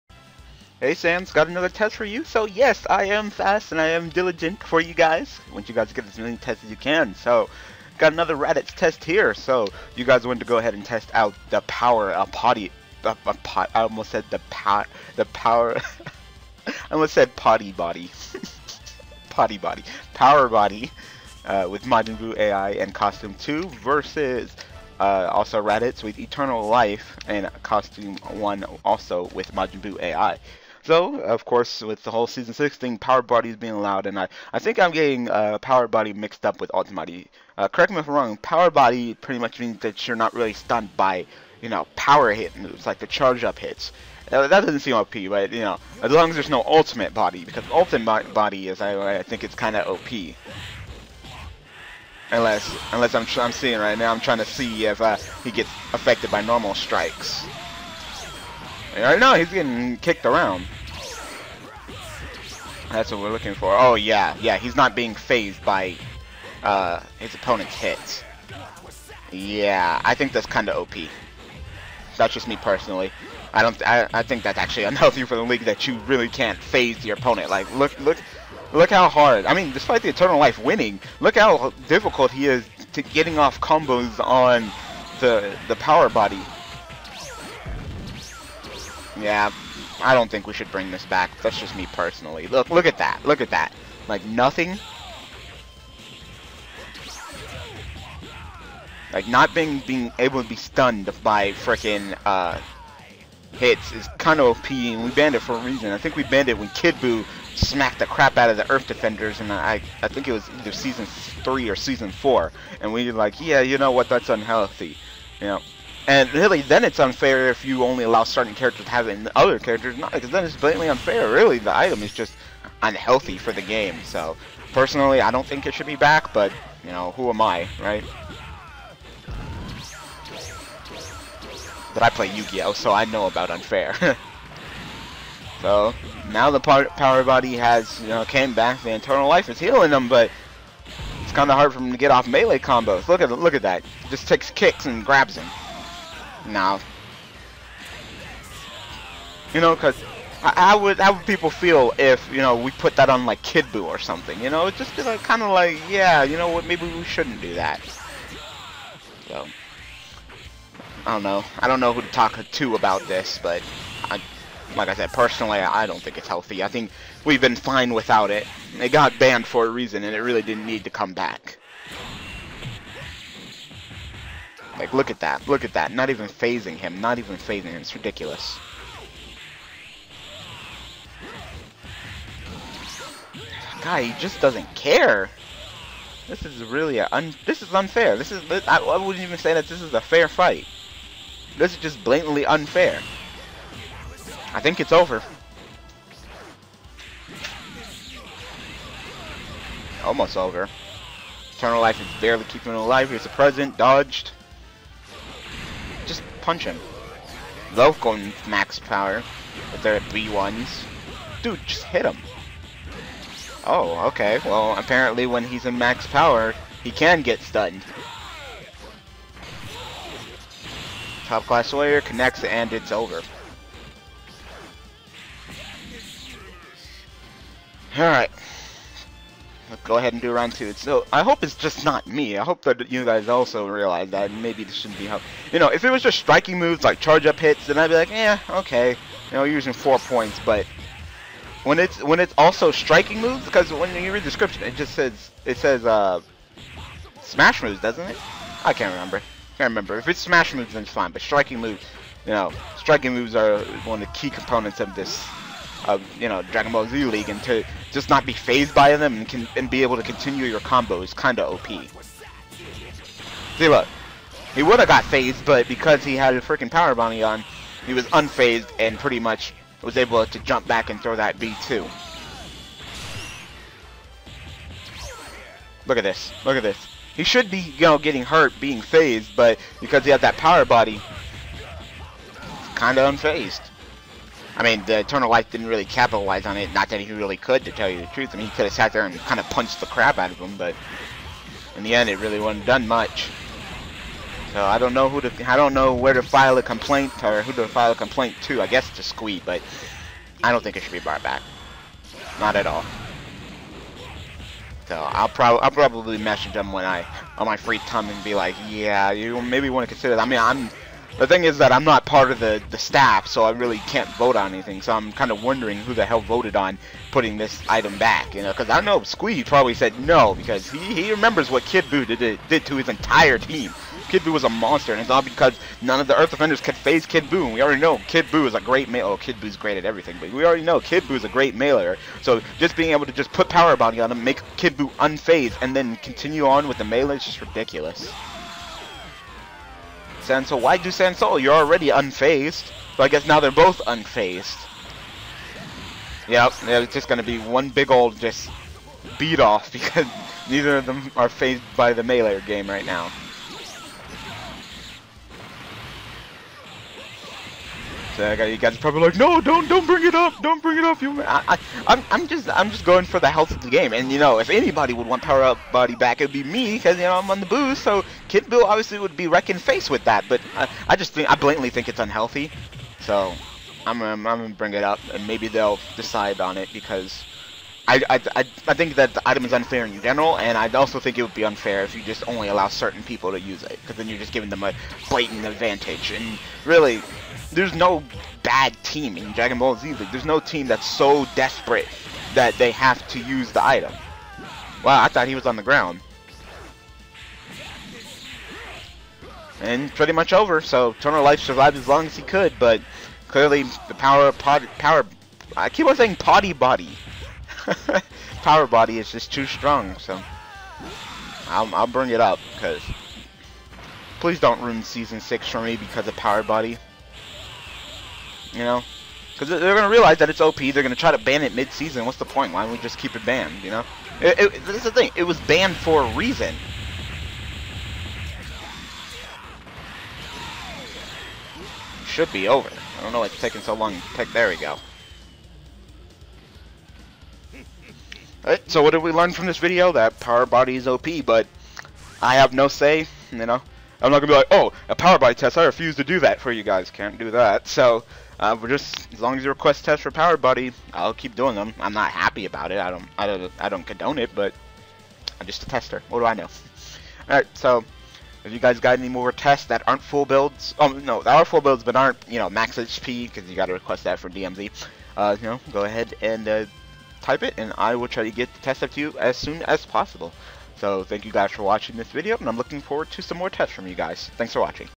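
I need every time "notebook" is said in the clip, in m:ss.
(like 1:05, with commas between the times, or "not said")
not said.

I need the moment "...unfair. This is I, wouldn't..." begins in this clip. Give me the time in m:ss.
3:07.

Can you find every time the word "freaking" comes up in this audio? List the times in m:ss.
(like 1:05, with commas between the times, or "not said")
4:26.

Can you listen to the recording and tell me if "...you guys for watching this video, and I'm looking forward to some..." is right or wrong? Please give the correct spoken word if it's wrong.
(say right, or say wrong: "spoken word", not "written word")
right.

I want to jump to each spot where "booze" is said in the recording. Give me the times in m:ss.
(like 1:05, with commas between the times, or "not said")
6:07.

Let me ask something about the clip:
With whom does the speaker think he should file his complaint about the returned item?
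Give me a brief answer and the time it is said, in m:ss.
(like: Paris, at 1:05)
Squee, at 4:59.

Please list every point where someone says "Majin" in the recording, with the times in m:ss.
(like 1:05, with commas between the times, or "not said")
0:21, 0:29.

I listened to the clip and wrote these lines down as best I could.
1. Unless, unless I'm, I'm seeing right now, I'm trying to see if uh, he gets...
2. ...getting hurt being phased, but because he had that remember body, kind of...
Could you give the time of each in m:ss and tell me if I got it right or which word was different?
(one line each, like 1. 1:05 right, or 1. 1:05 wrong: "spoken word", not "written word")
1. 0:52 right
2. 4:37 wrong: "power", not "remember".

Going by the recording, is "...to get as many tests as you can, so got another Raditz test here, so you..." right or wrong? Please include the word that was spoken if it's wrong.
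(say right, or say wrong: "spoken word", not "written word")
right.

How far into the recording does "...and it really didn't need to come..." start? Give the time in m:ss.
2:50.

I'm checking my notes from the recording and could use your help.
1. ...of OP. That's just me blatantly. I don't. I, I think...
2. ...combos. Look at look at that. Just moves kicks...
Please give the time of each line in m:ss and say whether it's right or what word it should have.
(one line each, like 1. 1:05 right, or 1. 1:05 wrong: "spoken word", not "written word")
1. 1:10 wrong: "personally", not "blatantly"
2. 2:22 wrong: "takes", not "moves".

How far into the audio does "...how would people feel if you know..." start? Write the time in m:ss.
2:30.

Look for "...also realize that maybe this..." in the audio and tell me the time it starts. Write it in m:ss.
3:53.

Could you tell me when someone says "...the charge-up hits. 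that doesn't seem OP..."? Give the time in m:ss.
0:42.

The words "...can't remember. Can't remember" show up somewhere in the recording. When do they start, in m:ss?
4:08.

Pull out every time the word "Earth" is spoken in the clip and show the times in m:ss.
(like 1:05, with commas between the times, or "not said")
1:48, 5:26.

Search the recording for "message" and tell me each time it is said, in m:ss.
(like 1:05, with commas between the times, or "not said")
5:06.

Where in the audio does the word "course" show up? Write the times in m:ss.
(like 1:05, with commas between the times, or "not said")
0:31.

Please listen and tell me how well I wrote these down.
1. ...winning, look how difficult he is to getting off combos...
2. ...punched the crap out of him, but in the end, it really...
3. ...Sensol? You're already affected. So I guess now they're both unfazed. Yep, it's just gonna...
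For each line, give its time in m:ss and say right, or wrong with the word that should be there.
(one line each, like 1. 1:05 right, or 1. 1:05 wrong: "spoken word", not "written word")
1. 1:20 right
2. 4:49 right
3. 5:40 wrong: "unfazed", not "affected".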